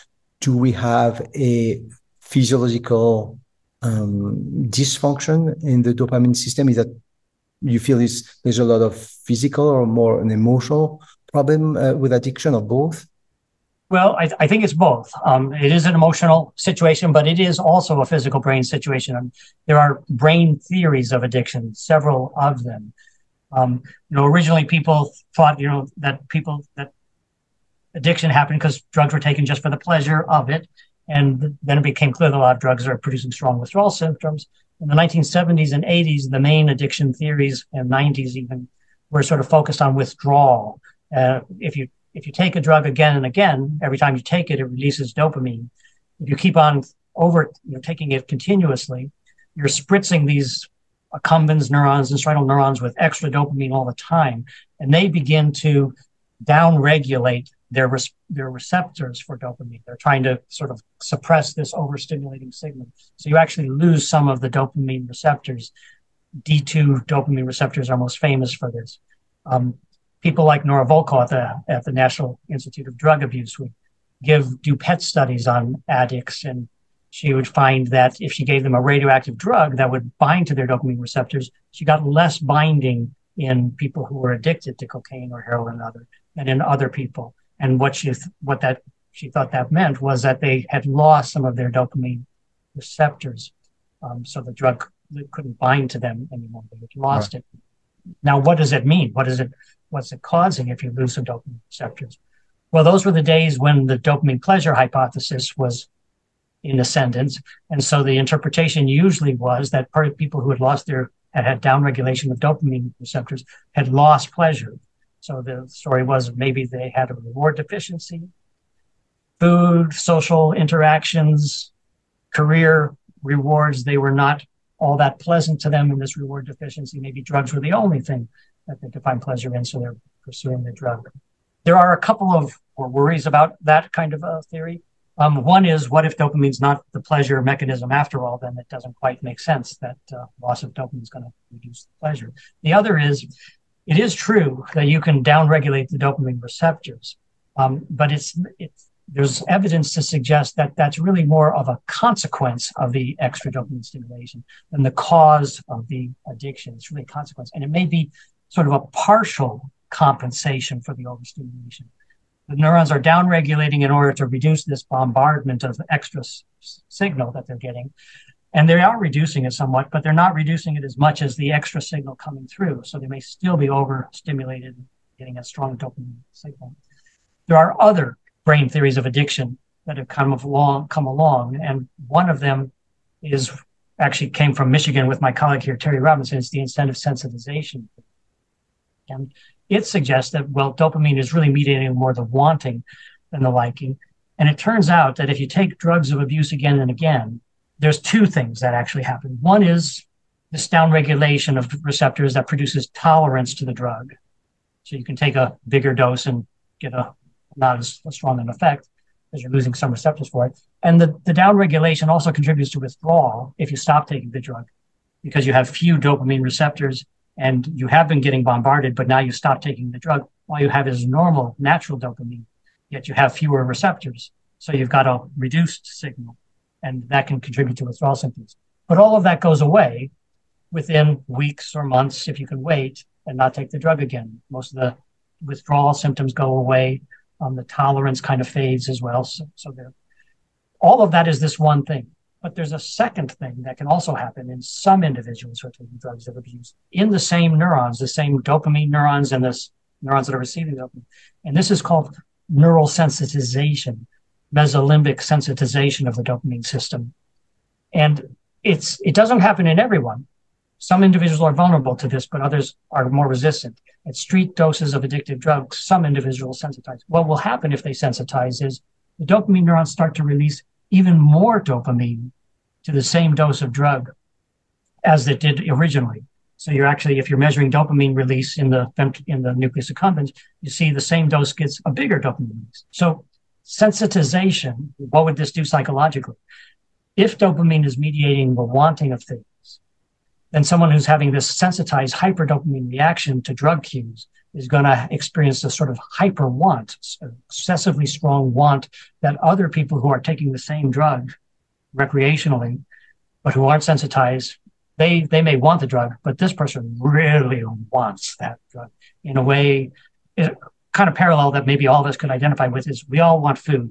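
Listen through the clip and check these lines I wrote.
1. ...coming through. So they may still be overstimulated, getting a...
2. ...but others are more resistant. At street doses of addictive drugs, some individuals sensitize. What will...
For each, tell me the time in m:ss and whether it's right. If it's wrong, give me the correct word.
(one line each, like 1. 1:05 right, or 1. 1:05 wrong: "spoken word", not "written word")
1. 2:52 right
2. 4:22 right.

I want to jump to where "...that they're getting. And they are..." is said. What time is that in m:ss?
2:47.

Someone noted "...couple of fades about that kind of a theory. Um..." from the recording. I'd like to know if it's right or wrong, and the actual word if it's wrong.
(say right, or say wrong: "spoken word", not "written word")
wrong: "worries", not "fades".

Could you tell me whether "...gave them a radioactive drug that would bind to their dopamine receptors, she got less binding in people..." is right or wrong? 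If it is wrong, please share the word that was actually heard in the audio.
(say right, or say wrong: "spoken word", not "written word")
right.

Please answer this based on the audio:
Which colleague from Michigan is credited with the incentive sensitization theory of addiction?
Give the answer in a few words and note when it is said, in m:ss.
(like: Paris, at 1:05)
Terry Robinson, at 3:05.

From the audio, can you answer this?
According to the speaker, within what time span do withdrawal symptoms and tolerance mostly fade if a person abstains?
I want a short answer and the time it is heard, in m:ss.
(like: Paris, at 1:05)
weeks or months, at 3:51.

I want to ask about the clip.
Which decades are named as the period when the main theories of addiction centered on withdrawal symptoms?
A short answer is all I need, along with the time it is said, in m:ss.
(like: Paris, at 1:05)
1970s and 80s, at 0:34.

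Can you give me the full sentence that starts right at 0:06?
Is that you feel is there's a lot of physical or more an emotional problem uh, with addiction or both?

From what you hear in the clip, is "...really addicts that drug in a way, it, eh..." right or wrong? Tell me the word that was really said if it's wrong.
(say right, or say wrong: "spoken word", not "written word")
wrong: "wants", not "addicts".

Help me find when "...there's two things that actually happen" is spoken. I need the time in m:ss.
3:17.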